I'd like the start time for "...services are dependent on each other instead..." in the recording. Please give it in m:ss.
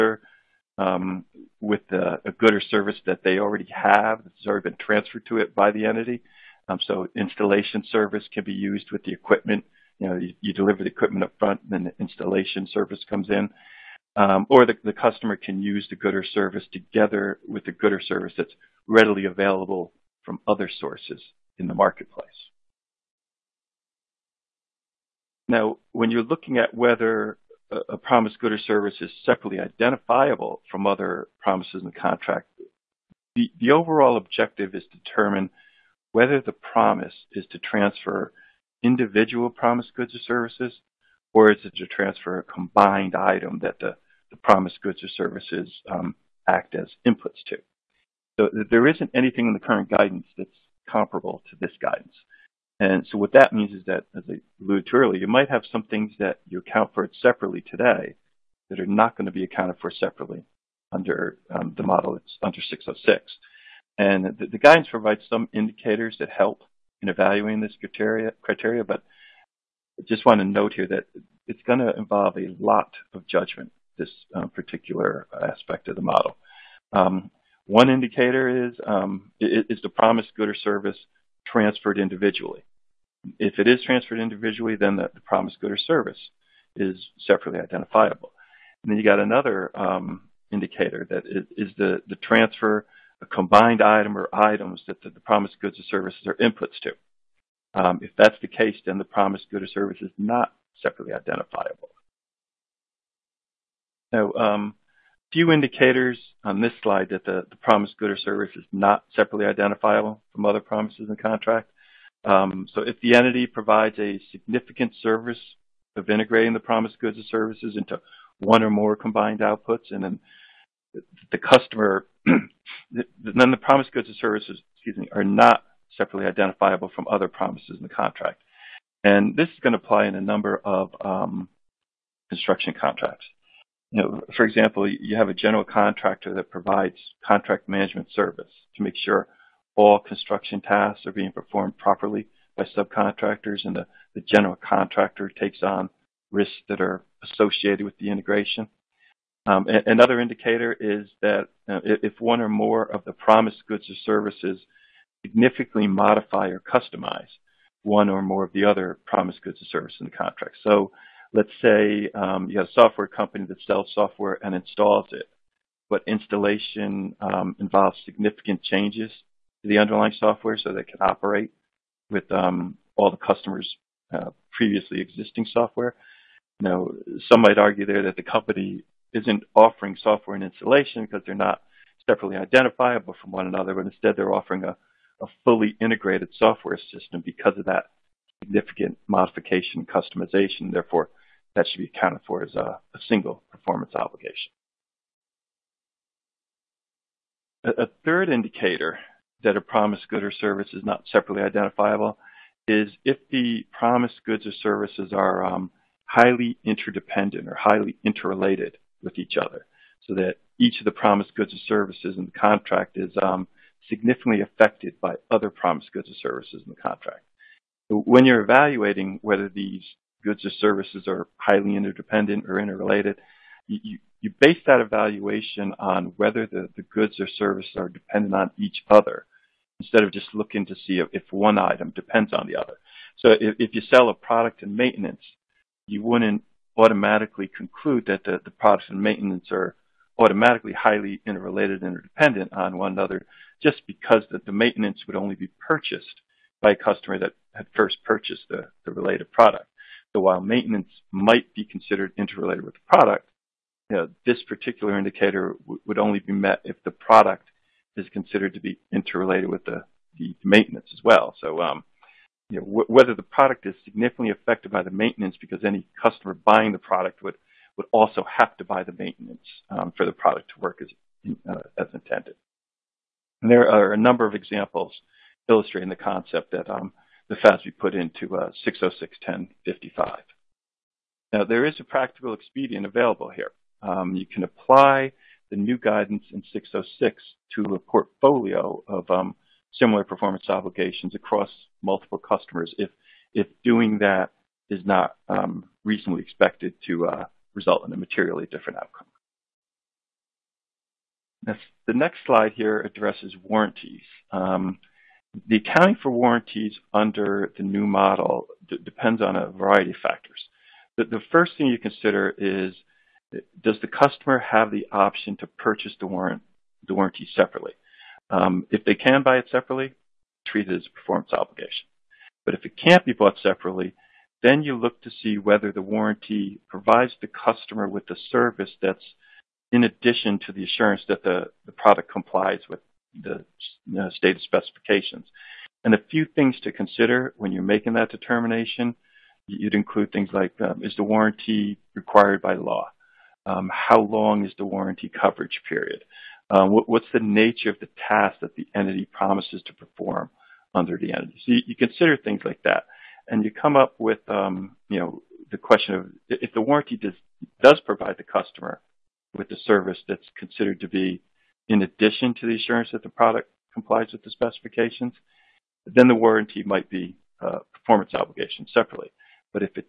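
3:47.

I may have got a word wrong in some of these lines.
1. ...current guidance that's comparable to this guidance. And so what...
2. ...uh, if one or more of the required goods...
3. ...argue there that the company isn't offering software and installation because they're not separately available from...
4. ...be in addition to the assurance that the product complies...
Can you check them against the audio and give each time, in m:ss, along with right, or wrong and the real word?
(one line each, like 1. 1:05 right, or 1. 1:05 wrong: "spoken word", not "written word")
1. 0:49 right
2. 2:31 wrong: "promised", not "required"
3. 2:57 wrong: "identifiable", not "available"
4. 6:00 right.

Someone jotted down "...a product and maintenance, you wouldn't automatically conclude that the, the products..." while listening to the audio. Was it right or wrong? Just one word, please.
right.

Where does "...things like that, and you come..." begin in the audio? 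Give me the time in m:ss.
5:52.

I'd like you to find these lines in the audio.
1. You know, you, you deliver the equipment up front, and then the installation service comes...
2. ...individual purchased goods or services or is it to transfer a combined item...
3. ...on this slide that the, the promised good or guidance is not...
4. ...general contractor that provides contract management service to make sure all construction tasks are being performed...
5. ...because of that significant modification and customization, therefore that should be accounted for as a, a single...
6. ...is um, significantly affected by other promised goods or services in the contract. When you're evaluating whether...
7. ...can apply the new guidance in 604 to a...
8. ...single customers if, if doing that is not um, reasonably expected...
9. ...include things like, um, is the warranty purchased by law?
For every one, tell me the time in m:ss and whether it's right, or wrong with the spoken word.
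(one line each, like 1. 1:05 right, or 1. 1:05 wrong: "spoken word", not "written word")
1. 0:09 right
2. 0:38 wrong: "promised", not "purchased"
3. 1:46 wrong: "service", not "guidance"
4. 2:15 right
5. 3:07 right
6. 3:32 right
7. 4:44 wrong: "606", not "604"
8. 4:51 wrong: "multiple", not "single"
9. 5:39 wrong: "required", not "purchased".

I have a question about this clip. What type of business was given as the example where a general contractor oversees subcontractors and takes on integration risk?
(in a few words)
Construction contracts.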